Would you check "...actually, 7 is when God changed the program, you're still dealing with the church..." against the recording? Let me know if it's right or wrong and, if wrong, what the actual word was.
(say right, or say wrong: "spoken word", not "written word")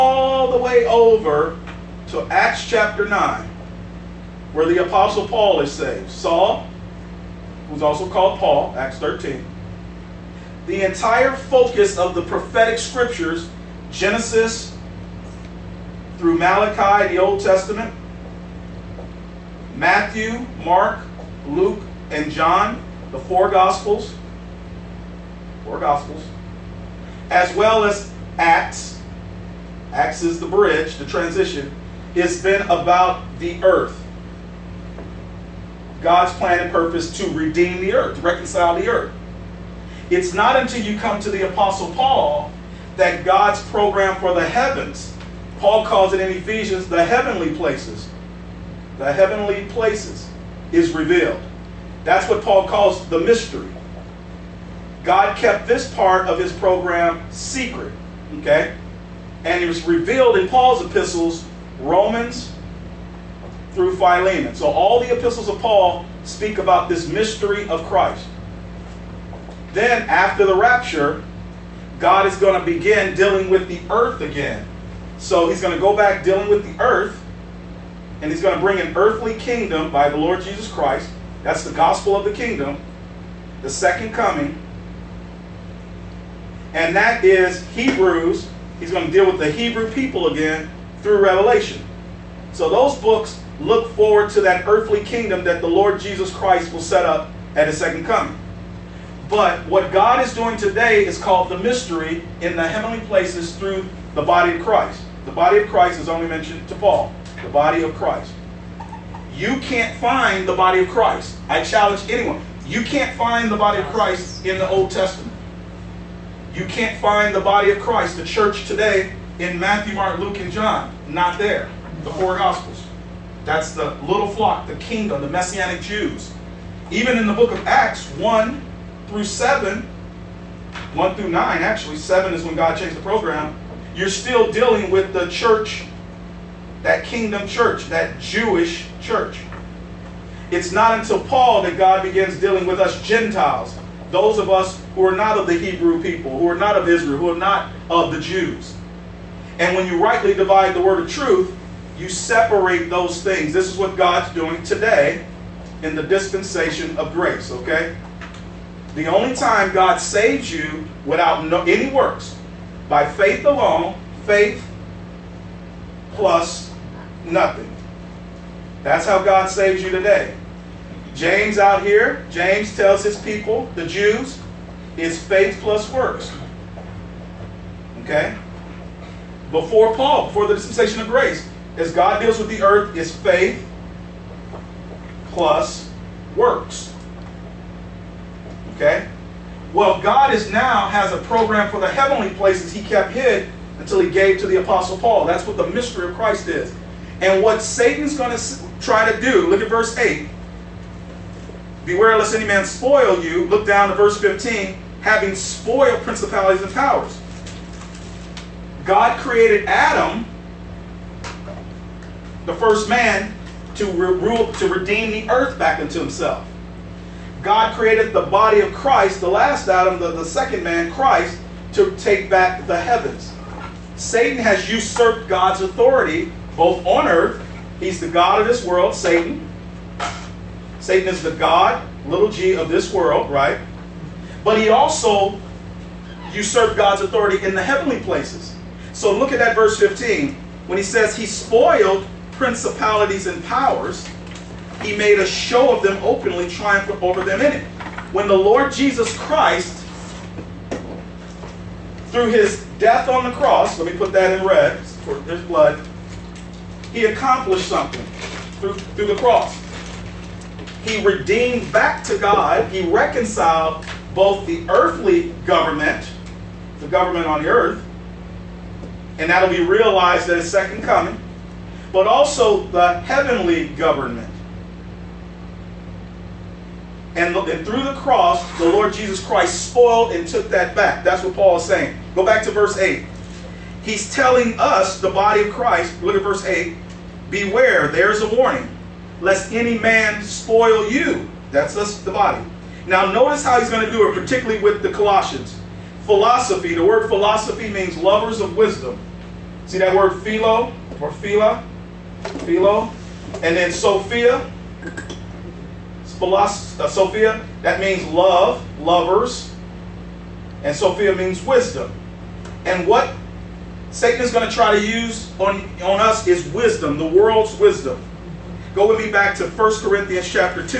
right.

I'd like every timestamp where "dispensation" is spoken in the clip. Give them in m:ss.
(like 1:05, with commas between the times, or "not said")
2:36, 3:00.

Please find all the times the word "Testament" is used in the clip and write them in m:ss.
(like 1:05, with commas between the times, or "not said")
0:17, 1:54.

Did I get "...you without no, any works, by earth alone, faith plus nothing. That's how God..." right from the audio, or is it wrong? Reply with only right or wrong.
wrong.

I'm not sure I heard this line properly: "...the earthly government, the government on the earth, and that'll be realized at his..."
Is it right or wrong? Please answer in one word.
right.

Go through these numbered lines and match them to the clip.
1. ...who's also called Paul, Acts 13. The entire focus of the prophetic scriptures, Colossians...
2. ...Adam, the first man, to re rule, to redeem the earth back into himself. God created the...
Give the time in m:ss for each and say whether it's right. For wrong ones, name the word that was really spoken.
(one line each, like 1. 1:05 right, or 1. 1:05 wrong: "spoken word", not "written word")
1. 0:07 wrong: "Genesis", not "Colossians"
2. 3:29 right.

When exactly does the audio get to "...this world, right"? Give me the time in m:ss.
3:52.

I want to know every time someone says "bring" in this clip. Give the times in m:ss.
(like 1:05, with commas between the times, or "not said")
1:18.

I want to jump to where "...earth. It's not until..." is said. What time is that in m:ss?
0:38.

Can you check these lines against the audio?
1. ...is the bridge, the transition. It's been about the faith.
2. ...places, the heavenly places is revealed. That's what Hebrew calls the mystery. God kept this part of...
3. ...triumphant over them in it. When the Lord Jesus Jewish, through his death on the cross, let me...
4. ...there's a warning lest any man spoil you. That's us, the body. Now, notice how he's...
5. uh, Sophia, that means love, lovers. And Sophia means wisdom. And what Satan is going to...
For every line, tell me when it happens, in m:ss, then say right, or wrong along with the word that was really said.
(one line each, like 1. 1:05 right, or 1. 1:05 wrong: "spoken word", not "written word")
1. 0:30 wrong: "earth", not "faith"
2. 0:47 wrong: "Paul", not "Hebrew"
3. 4:06 wrong: "Christ", not "Jewish"
4. 4:47 right
5. 5:06 right.